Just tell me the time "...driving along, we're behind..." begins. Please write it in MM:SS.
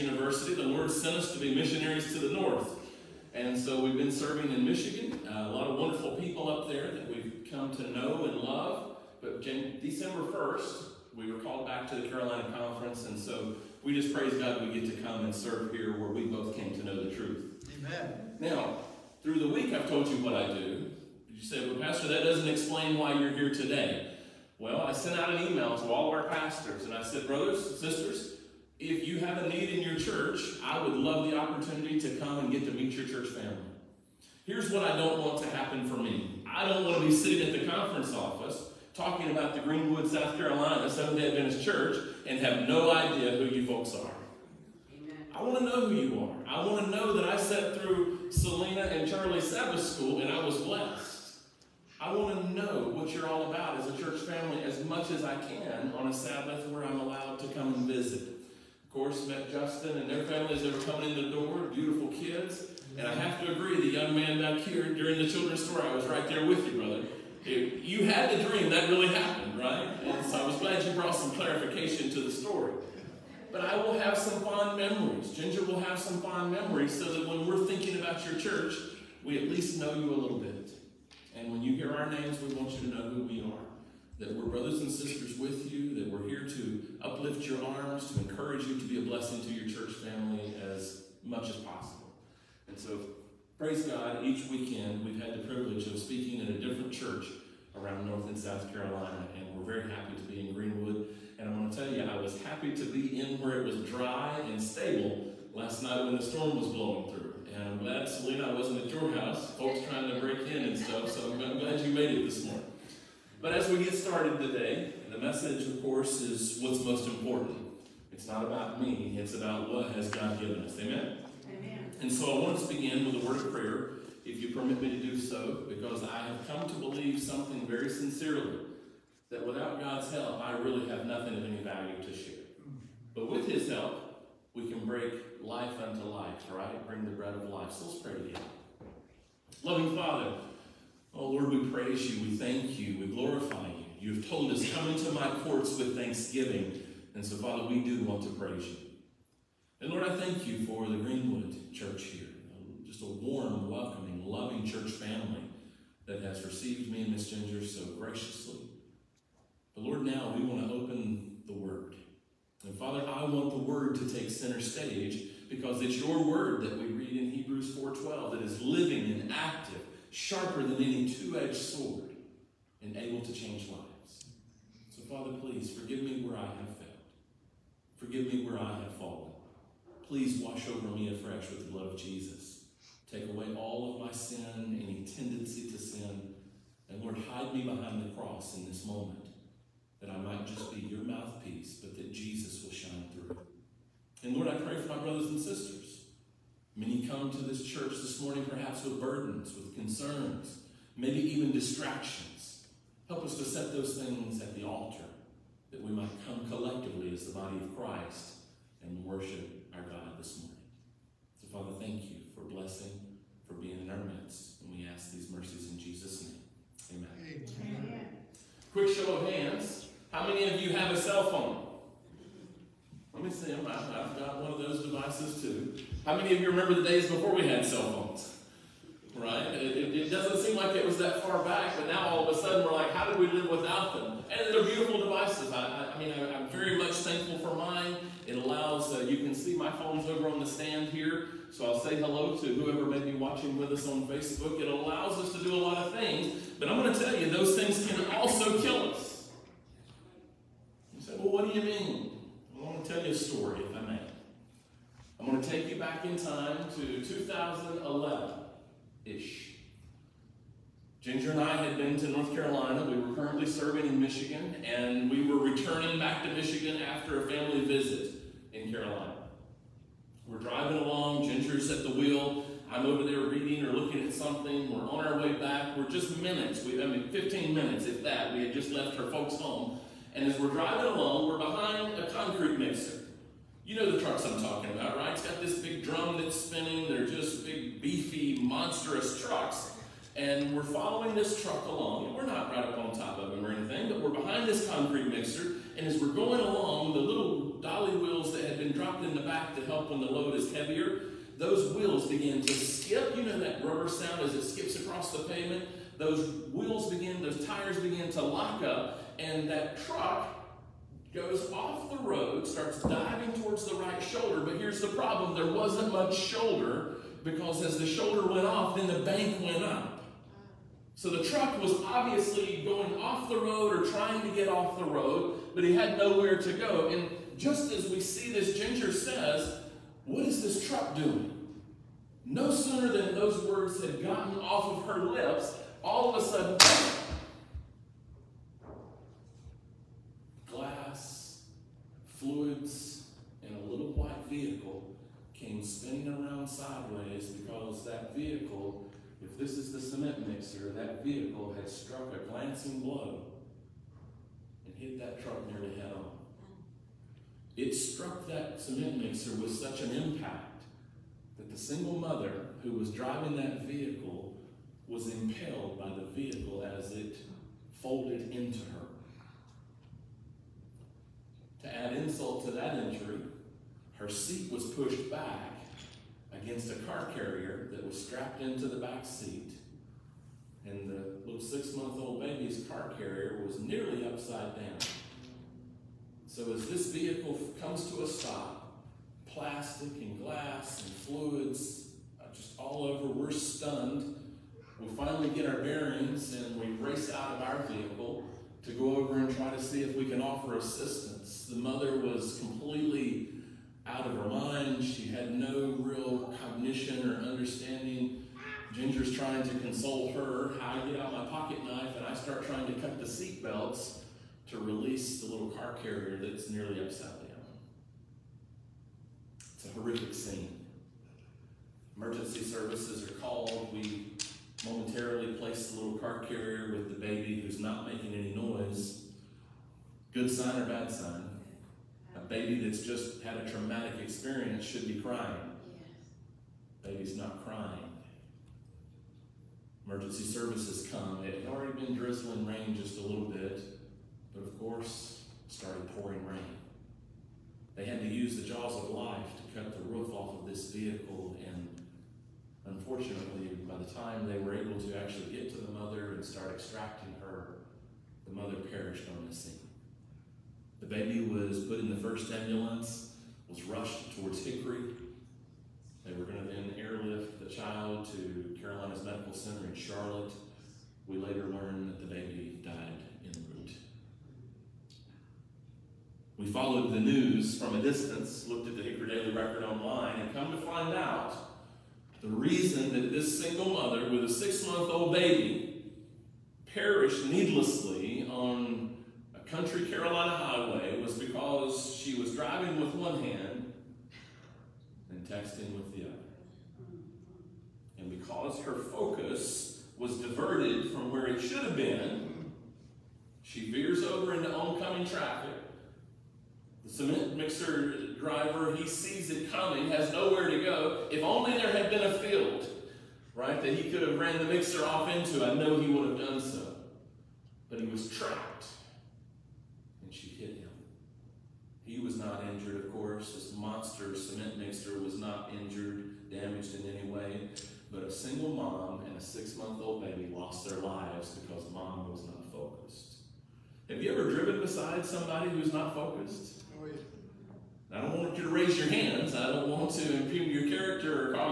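04:40.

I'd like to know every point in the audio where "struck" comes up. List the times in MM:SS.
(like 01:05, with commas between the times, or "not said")
05:51, 05:57.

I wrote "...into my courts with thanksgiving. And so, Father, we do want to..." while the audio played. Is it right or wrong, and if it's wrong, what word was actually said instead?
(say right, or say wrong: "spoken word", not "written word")
right.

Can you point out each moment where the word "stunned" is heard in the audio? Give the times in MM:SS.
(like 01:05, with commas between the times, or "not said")
06:33.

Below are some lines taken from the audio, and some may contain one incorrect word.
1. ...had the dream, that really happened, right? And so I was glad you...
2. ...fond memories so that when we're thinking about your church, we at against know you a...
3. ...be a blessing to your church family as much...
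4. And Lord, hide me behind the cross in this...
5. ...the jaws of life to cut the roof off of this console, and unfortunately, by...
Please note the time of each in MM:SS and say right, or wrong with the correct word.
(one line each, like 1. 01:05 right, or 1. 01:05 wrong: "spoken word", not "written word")
1. 01:08 right
2. 01:16 wrong: "least", not "against"
3. 01:28 right
4. 03:06 right
5. 07:28 wrong: "vehicle", not "console".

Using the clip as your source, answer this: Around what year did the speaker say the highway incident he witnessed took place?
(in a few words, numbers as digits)
2011.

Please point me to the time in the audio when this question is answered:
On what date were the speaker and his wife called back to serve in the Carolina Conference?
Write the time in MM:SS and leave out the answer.
00:09.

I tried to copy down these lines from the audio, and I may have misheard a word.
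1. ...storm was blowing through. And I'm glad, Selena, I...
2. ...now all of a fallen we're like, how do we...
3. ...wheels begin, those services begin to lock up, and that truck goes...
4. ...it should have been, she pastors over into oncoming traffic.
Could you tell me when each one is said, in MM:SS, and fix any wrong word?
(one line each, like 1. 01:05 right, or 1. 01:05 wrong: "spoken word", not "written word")
1. 01:46 right
2. 03:51 wrong: "sudden", not "fallen"
3. 05:06 wrong: "tires", not "services"
4. 08:21 wrong: "veers", not "pastors".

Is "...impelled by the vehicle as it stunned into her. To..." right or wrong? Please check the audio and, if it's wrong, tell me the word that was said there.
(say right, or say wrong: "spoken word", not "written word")
wrong: "folded", not "stunned".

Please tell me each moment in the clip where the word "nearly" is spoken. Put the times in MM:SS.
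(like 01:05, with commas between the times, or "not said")
05:55, 06:23, 06:56.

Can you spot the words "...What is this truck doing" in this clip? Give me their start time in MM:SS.
05:30.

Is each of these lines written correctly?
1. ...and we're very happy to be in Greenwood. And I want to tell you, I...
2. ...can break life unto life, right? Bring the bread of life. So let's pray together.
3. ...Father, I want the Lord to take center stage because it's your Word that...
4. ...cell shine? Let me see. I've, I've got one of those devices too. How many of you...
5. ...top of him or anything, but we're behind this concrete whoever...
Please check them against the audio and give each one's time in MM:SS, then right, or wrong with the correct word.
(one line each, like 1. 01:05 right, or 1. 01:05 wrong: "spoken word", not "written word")
1. 01:39 right
2. 02:14 right
3. 02:42 wrong: "Word", not "Lord"
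4. 03:40 wrong: "phone", not "shine"
5. 04:52 wrong: "mixer", not "whoever".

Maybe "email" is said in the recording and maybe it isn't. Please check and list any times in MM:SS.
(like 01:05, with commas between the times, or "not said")
00:25.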